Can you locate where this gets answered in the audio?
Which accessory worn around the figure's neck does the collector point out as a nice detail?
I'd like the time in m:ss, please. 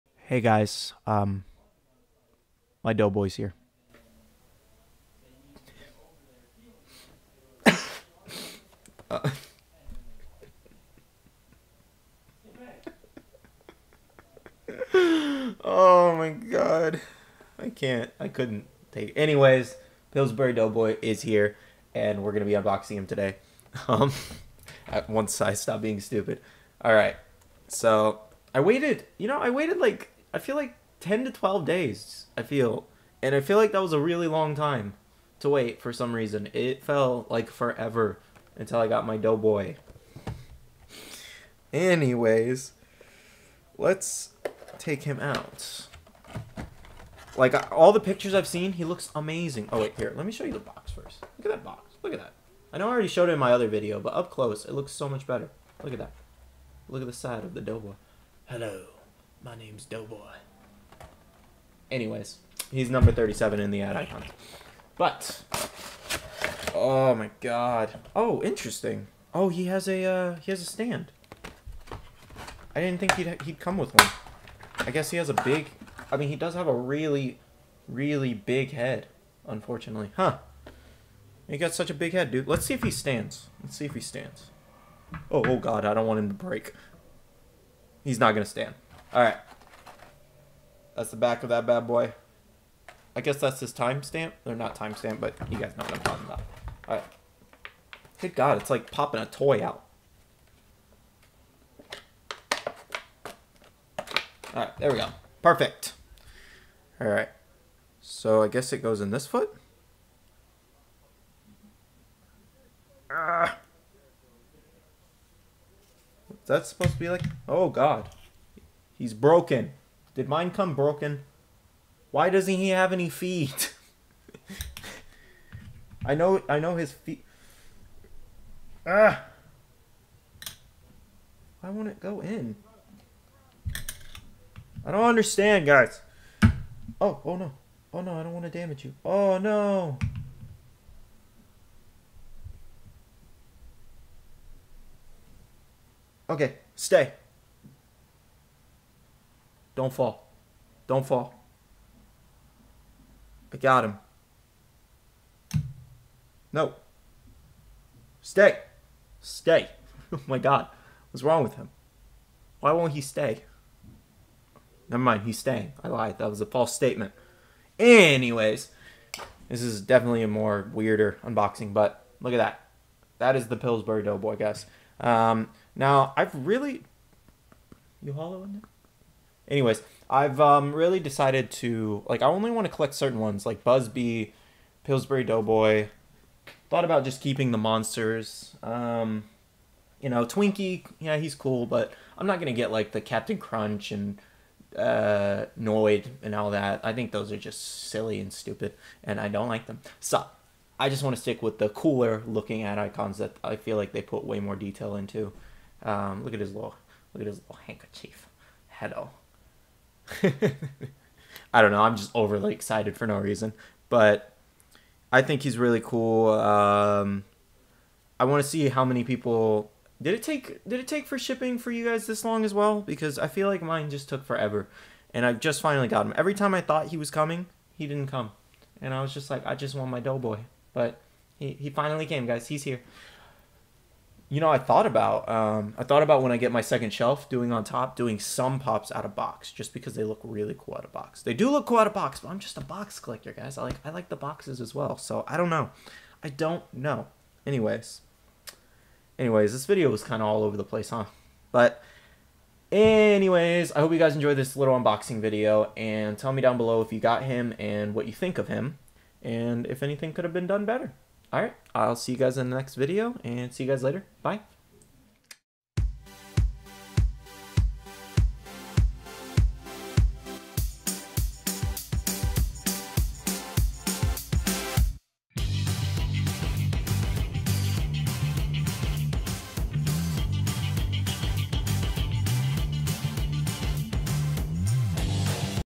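3:27.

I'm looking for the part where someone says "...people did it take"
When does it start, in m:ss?
3:39.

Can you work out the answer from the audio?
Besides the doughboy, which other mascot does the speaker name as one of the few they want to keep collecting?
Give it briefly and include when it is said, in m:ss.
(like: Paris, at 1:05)
Busby, at 3:03.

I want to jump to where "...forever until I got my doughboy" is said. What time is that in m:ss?
0:37.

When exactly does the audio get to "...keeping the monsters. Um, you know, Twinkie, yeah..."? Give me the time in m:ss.
3:07.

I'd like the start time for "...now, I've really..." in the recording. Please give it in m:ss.
2:55.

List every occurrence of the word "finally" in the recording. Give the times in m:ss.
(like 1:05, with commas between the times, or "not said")
3:45, 3:51.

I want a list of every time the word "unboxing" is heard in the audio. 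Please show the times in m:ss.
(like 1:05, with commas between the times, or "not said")
0:22, 2:51, 4:14.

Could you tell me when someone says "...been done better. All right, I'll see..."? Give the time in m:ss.
4:20.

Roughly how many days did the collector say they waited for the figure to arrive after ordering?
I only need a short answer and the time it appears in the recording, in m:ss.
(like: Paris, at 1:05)
10 to 12 days, at 0:31.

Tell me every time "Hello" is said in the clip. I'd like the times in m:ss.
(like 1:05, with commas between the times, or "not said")
0:58, 3:28.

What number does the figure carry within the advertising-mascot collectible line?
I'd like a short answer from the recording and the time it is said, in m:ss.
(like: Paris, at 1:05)
37, at 1:03.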